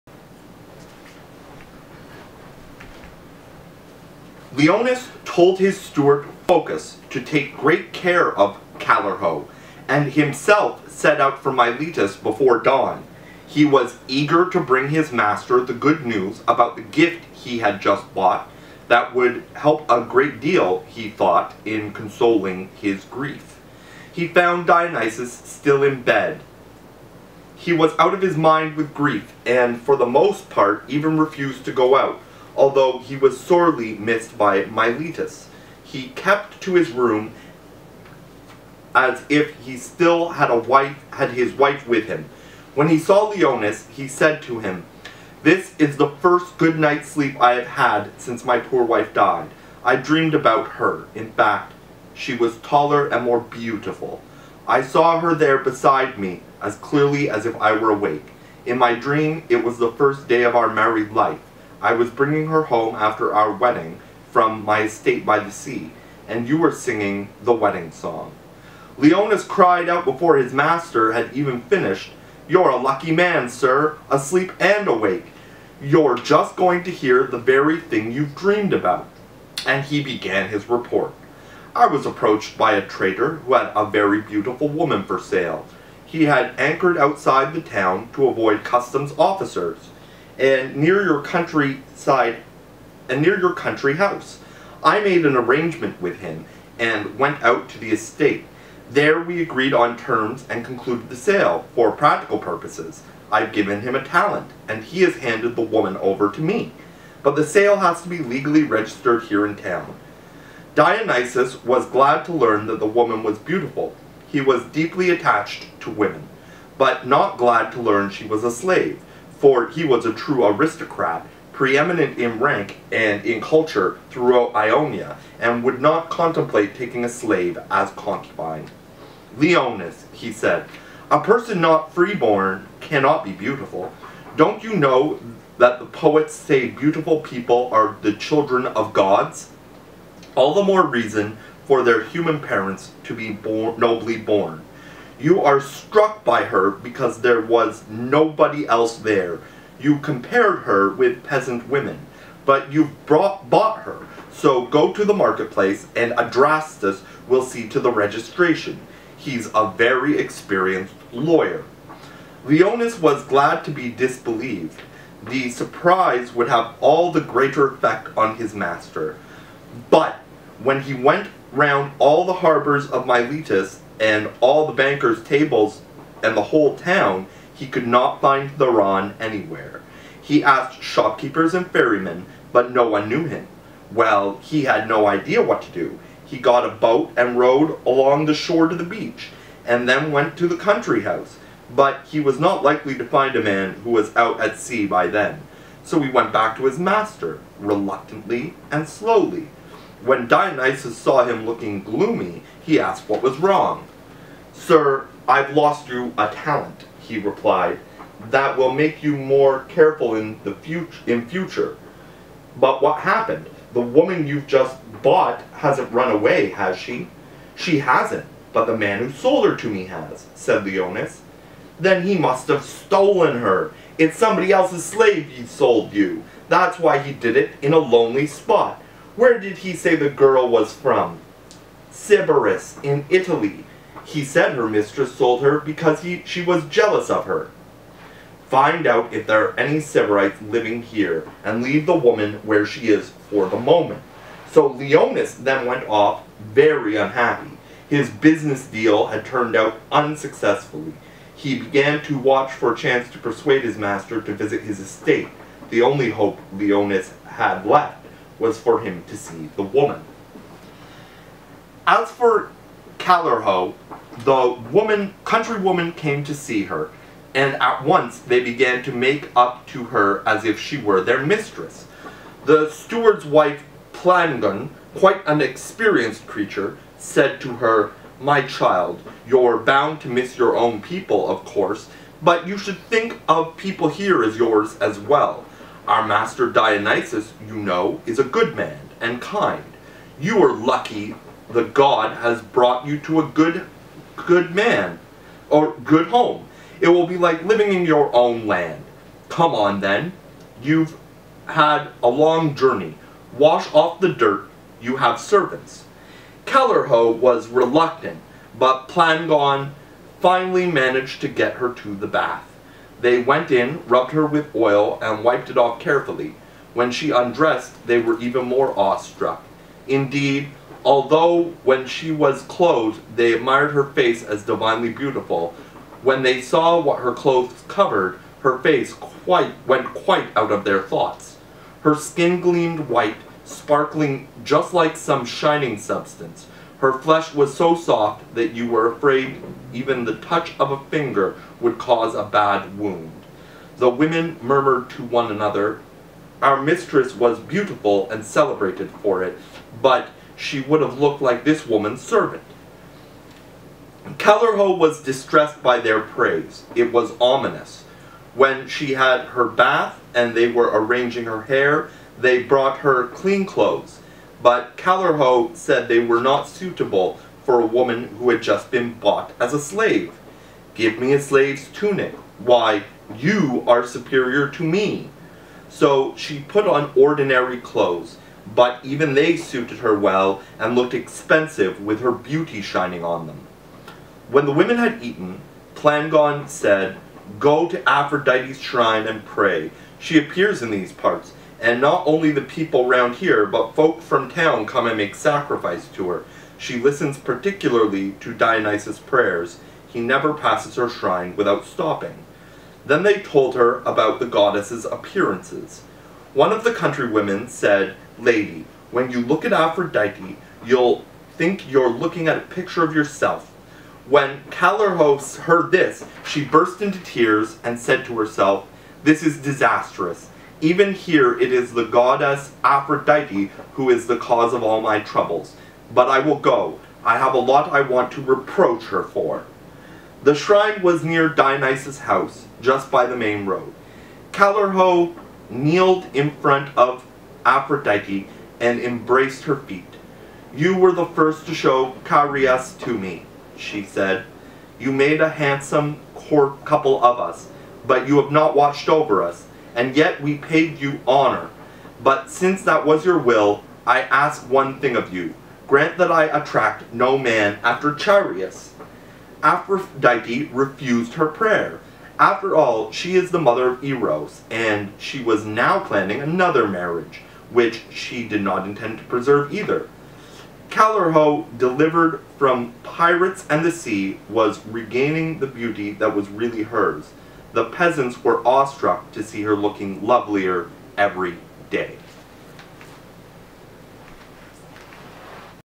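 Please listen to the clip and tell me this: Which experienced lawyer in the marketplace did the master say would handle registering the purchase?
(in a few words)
Adrastus.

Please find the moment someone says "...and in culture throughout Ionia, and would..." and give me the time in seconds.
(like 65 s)
122 s.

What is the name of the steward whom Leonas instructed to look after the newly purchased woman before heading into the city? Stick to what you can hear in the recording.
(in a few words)
Phocas.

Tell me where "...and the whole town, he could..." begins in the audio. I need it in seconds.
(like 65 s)
176 s.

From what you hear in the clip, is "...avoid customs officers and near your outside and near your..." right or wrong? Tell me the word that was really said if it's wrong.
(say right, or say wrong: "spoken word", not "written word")
wrong: "countryside", not "outside".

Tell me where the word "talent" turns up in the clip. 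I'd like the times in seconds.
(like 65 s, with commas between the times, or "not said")
104 s, 206 s.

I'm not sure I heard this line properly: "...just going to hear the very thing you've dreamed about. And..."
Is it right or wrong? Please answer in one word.
right.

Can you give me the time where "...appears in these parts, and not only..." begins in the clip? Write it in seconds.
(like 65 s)
390 s.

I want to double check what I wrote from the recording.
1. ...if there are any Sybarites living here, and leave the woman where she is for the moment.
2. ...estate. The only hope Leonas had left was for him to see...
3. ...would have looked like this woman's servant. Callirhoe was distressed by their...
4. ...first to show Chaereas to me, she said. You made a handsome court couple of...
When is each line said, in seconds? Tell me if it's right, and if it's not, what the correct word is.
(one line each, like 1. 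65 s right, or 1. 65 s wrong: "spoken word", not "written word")
1. 239 s right
2. 254 s right
3. 350 s right
4. 441 s right.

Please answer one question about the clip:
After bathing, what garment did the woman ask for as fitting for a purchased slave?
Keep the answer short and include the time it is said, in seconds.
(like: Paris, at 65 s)
a slave's tunic, at 371 s.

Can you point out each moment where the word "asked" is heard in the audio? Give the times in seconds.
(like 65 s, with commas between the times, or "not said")
180 s, 202 s.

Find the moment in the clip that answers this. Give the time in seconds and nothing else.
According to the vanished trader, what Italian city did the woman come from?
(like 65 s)
231 s.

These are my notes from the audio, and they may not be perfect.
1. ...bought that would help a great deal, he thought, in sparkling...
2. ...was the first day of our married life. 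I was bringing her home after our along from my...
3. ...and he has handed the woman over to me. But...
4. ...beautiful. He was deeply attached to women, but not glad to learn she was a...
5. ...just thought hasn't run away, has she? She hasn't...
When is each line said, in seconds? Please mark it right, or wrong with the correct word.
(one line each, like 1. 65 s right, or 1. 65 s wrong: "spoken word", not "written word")
1. 18 s wrong: "consoling", not "sparkling"
2. 59 s wrong: "wedding", not "along"
3. 104 s right
4. 113 s right
5. 214 s wrong: "bought", not "thought".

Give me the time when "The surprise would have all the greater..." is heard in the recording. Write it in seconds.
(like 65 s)
165 s.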